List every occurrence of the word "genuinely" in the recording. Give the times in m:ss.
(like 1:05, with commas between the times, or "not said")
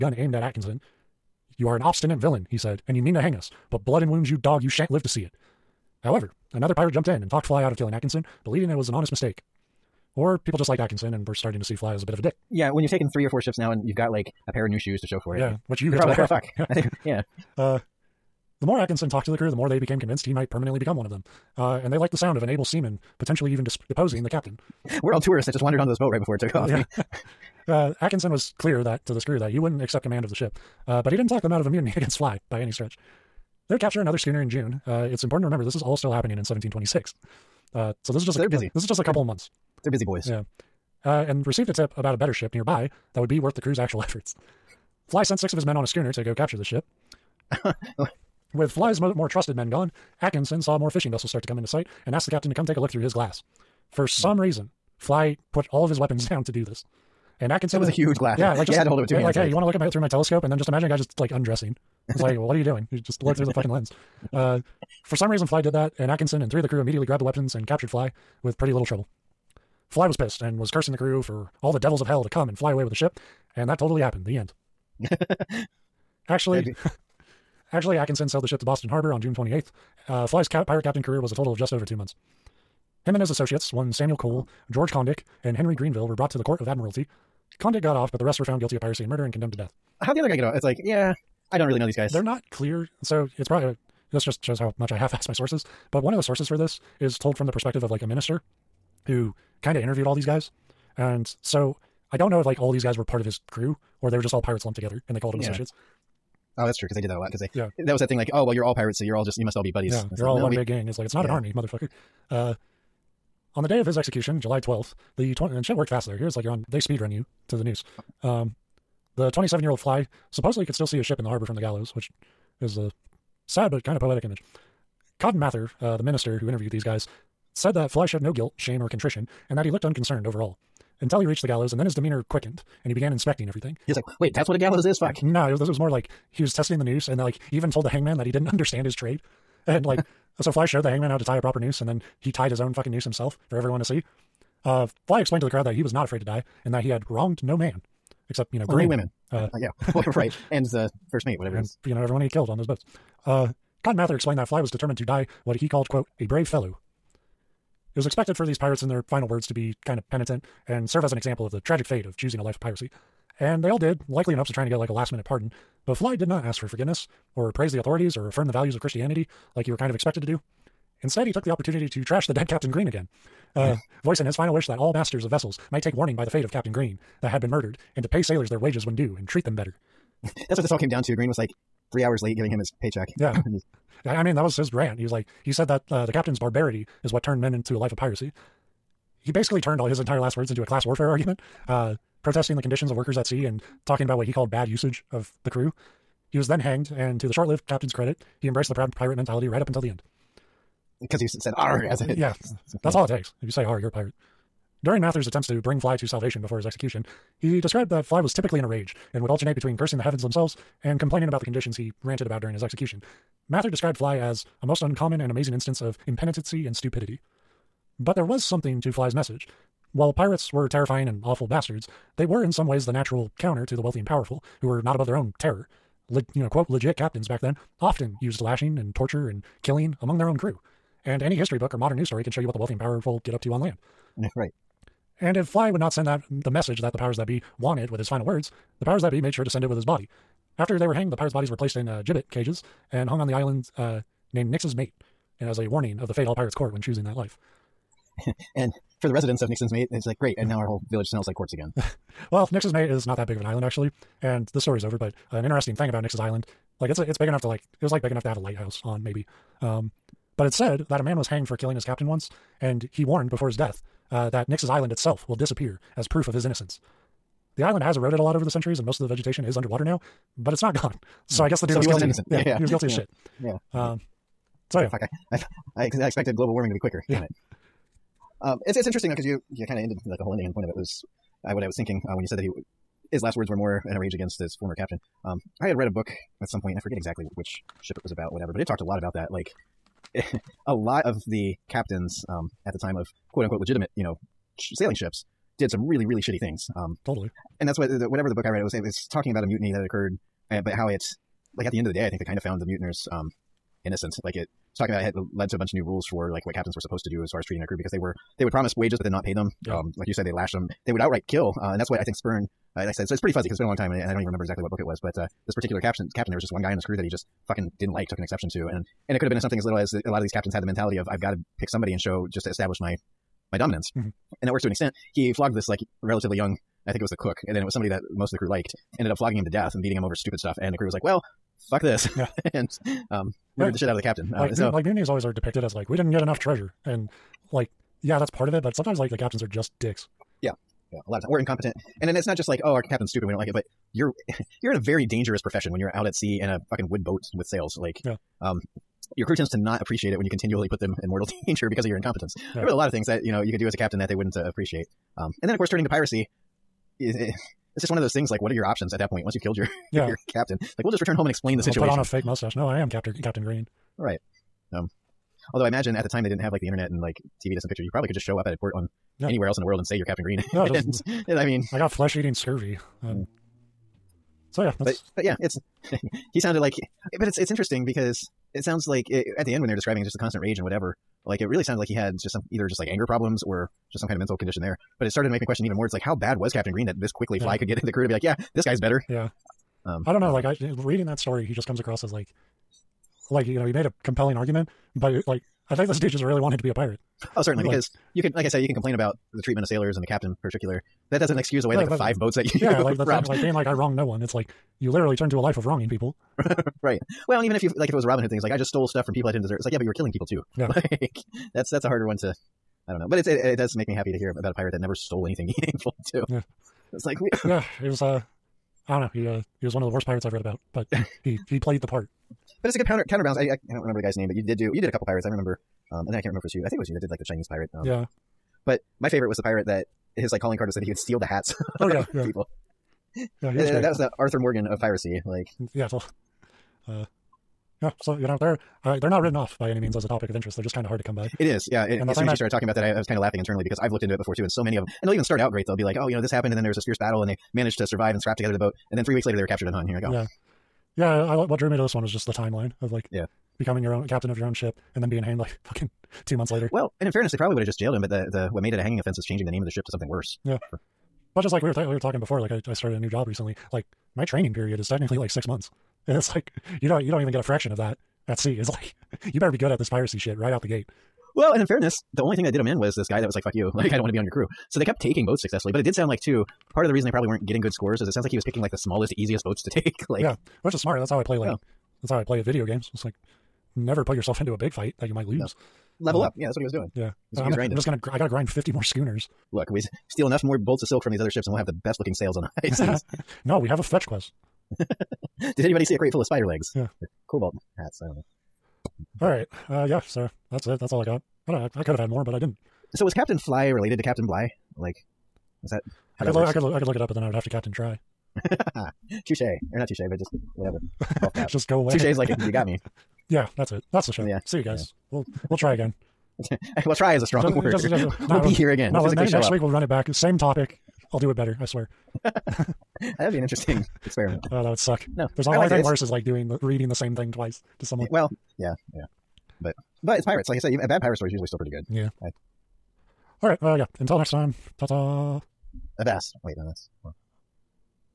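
not said.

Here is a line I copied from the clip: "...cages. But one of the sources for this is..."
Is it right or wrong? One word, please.
wrong.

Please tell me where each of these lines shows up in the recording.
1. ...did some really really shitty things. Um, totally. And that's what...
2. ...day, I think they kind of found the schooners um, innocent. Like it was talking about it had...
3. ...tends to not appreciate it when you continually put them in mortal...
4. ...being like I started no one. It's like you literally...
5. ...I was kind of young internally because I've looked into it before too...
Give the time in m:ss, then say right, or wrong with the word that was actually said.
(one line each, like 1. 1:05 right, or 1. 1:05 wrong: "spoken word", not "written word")
1. 4:55 right
2. 5:01 wrong: "mutineers", not "schooners"
3. 5:49 right
4. 6:43 wrong: "wronged", not "started"
5. 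7:22 wrong: "laughing", not "young".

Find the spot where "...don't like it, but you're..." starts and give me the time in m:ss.
5:43.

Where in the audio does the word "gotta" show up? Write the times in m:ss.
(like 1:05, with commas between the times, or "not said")
8:08.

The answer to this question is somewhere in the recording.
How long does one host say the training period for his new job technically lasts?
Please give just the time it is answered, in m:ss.
7:45.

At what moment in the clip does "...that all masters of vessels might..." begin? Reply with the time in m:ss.
2:54.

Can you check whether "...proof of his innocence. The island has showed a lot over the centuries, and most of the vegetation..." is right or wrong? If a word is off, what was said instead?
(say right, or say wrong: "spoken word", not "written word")
wrong: "eroded", not "showed".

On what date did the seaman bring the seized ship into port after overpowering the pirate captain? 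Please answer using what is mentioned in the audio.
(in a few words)
June 28th.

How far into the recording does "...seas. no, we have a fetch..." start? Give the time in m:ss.
8:12.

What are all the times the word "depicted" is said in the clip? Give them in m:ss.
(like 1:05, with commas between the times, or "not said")
5:35.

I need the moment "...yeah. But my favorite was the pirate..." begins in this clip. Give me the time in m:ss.
7:07.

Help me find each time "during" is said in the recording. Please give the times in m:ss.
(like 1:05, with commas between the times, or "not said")
3:24, 3:32.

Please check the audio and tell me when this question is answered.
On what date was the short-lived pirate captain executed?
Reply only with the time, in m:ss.
1:54.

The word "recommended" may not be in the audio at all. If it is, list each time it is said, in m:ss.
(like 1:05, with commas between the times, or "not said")
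not said.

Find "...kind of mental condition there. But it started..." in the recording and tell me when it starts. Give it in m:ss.
6:24.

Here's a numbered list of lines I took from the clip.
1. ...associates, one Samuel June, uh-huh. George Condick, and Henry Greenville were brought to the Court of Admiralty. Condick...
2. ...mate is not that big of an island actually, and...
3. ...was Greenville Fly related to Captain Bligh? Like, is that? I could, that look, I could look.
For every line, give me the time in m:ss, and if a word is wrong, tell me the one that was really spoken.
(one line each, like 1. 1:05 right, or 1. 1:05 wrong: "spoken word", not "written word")
1. 1:23 wrong: "Cole", not "June"
2. 4:12 right
3. 8:23 wrong: "Captain", not "Greenville".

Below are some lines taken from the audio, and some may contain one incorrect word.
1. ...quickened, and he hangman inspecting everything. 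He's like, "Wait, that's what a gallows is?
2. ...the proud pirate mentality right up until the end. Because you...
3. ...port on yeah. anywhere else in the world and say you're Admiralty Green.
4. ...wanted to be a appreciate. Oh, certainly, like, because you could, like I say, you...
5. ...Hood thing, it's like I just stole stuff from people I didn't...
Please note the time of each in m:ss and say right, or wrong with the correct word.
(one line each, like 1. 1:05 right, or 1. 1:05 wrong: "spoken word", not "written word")
1. 2:12 wrong: "began", not "hangman"
2. 3:18 right
3. 6:08 wrong: "Captain", not "Admiralty"
4. 6:36 wrong: "pirate", not "appreciate"
5. 6:48 right.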